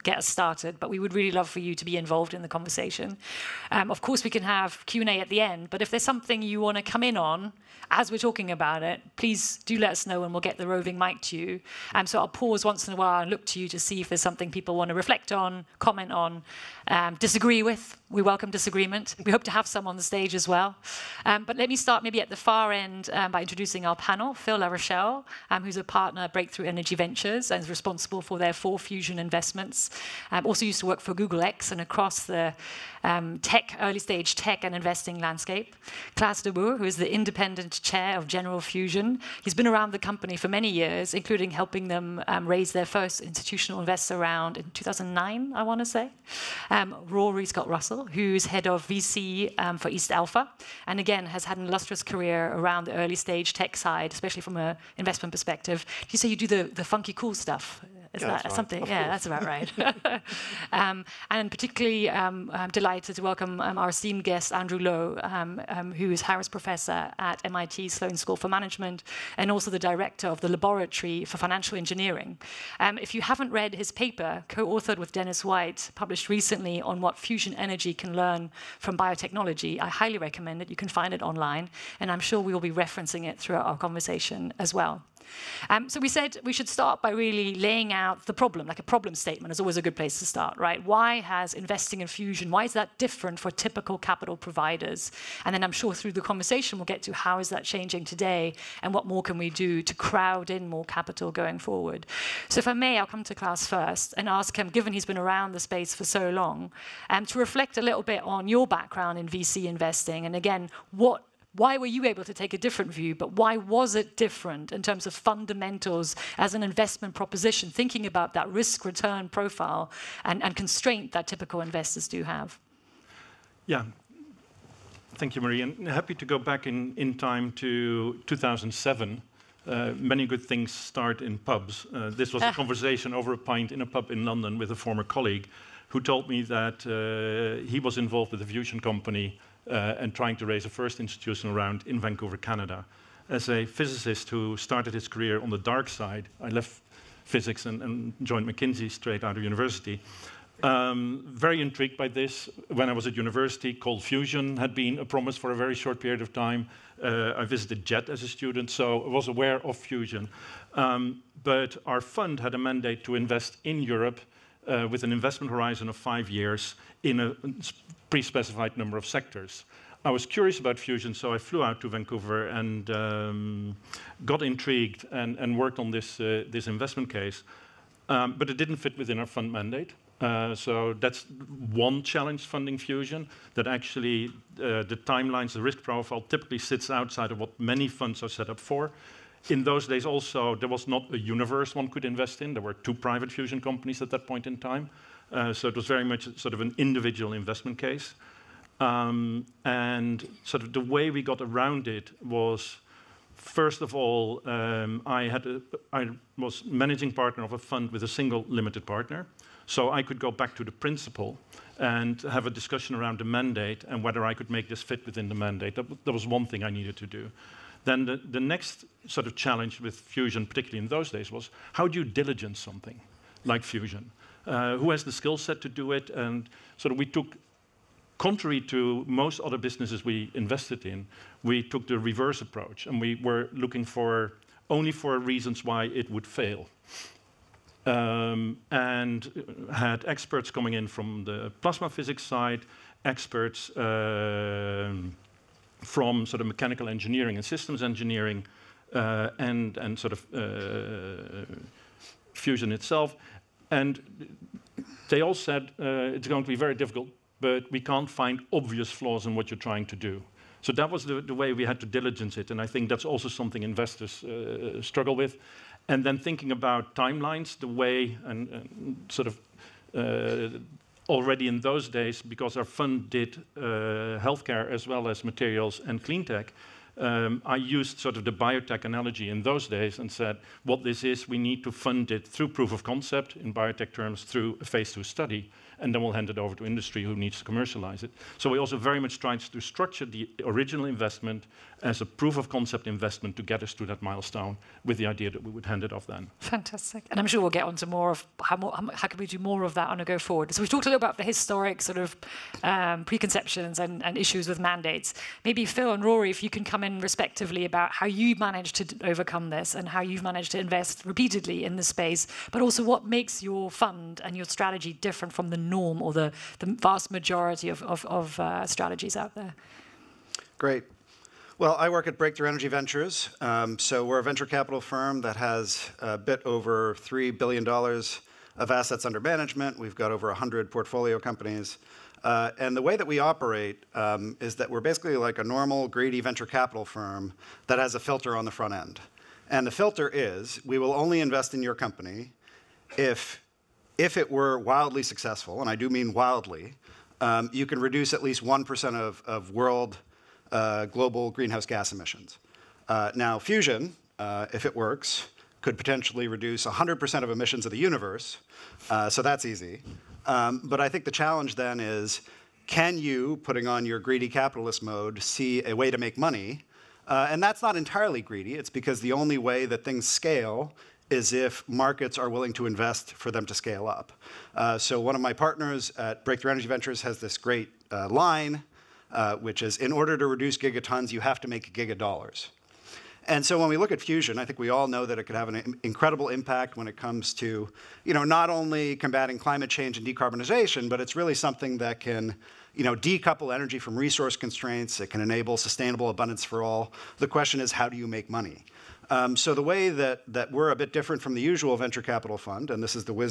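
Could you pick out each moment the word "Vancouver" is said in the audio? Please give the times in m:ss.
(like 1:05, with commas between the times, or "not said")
2:21, 2:51.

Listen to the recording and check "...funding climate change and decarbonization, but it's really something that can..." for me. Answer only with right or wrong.
wrong.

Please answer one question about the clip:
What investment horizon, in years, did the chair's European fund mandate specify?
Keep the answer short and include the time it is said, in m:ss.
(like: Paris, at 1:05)
5 years, at 2:45.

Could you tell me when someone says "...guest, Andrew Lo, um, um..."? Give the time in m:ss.
1:04.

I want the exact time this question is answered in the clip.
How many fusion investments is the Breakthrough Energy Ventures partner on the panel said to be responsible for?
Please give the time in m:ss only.
0:28.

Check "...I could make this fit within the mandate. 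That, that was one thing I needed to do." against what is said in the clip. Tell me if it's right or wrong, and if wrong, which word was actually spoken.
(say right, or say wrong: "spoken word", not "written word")
right.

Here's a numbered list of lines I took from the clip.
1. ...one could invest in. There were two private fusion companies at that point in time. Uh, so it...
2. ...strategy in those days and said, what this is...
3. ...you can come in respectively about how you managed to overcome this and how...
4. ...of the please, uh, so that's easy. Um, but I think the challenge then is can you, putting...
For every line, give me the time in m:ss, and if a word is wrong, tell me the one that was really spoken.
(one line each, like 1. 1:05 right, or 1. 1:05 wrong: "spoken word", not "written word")
1. 3:11 right
2. 4:38 wrong: "analogy", not "strategy"
3. 5:06 right
4. 5:57 wrong: "universe", not "please".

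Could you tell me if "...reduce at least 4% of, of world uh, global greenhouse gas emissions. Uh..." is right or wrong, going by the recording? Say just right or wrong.
wrong.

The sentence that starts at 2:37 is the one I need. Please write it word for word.
Uh, I visited JET as a student, so I was aware of fusion.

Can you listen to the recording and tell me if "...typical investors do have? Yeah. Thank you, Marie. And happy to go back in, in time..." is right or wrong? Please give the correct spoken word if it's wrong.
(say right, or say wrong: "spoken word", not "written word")
right.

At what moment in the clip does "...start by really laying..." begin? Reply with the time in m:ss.
1:26.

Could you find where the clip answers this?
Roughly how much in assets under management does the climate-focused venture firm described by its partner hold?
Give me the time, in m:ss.
5:26.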